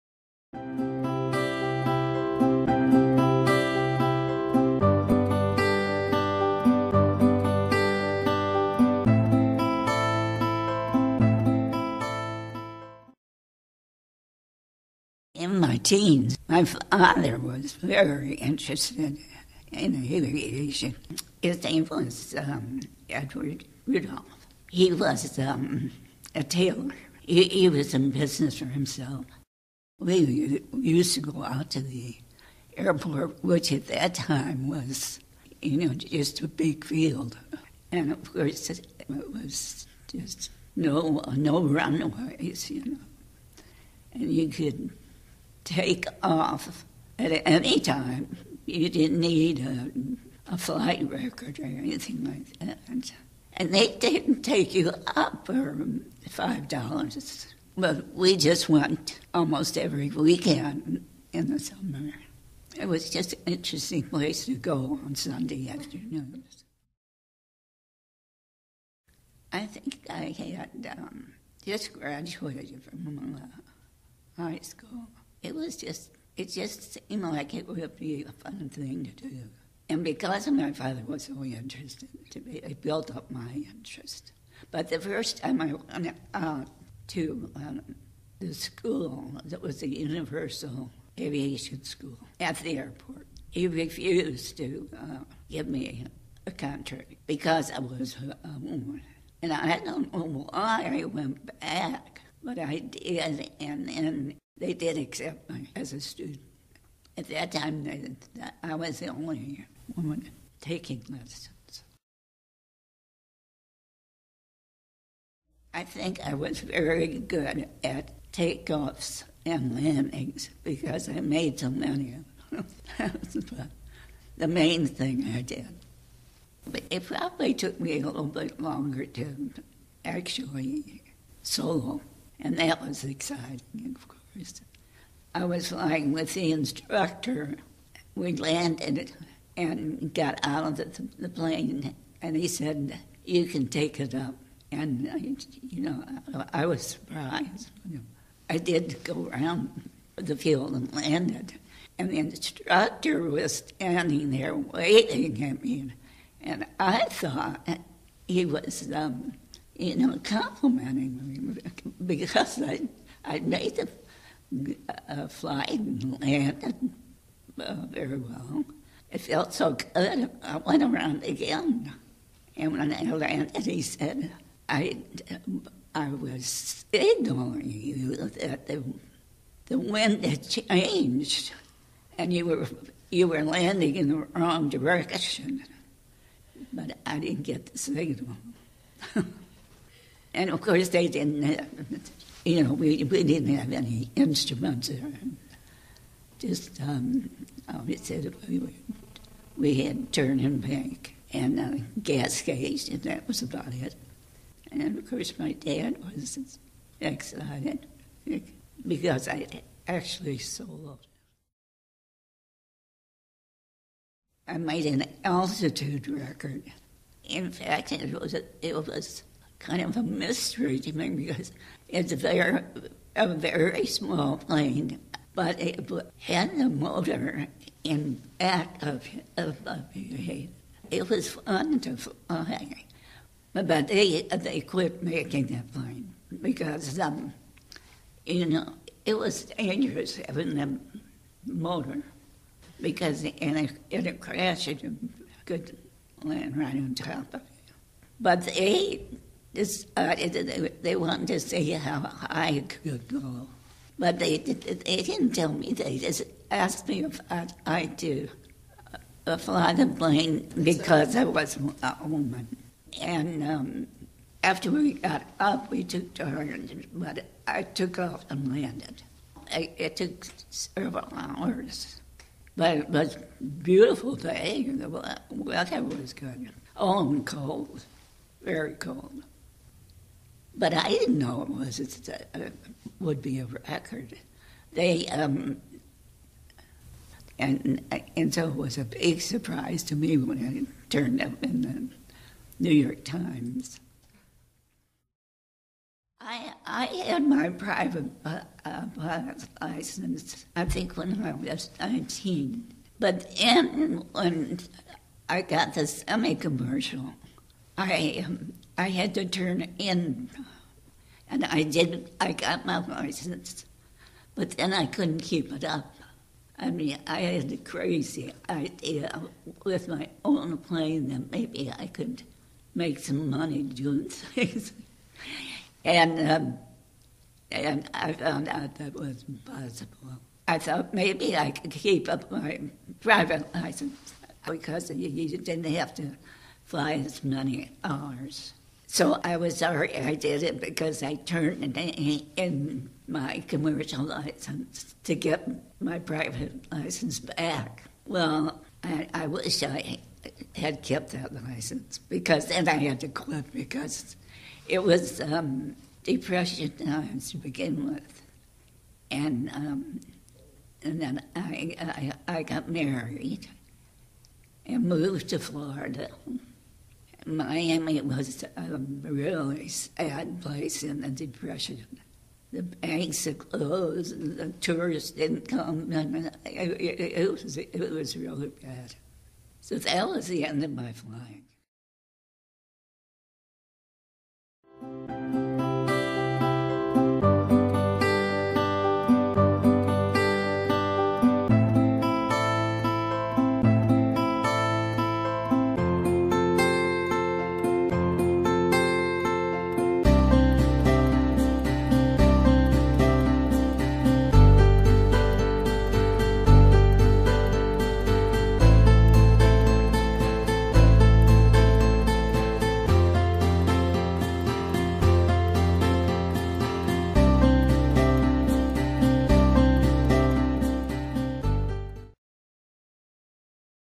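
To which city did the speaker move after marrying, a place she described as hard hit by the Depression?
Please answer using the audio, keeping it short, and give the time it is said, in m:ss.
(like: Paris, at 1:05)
Miami, at 6:07.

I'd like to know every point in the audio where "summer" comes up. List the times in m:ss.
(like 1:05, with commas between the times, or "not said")
1:01.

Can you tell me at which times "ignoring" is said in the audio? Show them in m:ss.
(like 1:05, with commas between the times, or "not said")
2:56.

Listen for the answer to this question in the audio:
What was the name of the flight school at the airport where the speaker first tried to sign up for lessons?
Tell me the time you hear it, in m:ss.
1:29.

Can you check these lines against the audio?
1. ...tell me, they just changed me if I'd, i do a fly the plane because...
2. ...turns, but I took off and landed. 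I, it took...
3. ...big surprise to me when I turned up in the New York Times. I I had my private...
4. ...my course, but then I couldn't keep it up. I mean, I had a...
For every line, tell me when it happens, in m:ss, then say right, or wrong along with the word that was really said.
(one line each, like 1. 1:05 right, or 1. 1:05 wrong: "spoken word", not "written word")
1. 4:15 wrong: "asked", not "changed"
2. 4:26 right
3. 4:48 right
4. 5:12 wrong: "license", not "course".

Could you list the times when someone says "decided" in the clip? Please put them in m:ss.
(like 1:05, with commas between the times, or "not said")
4:09.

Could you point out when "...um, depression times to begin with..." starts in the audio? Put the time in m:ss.
5:55.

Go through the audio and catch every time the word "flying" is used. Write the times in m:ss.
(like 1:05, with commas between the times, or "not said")
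2:15, 6:20.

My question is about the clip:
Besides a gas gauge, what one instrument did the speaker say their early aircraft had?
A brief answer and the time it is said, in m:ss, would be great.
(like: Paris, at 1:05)
Turn and bank, at 3:20.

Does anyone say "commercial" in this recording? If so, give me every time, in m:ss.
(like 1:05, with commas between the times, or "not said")
5:06, 5:43.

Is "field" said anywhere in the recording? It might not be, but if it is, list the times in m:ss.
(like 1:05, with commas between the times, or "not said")
0:36, 2:30.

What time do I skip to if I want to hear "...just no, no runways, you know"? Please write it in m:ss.
0:40.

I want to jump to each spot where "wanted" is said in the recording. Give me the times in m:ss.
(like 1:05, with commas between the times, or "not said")
4:10.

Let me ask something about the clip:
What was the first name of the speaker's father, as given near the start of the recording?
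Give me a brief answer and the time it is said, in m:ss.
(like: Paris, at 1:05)
Edward, at 0:23.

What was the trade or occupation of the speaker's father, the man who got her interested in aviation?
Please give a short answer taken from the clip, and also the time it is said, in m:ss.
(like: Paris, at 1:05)
Tailor, at 0:26.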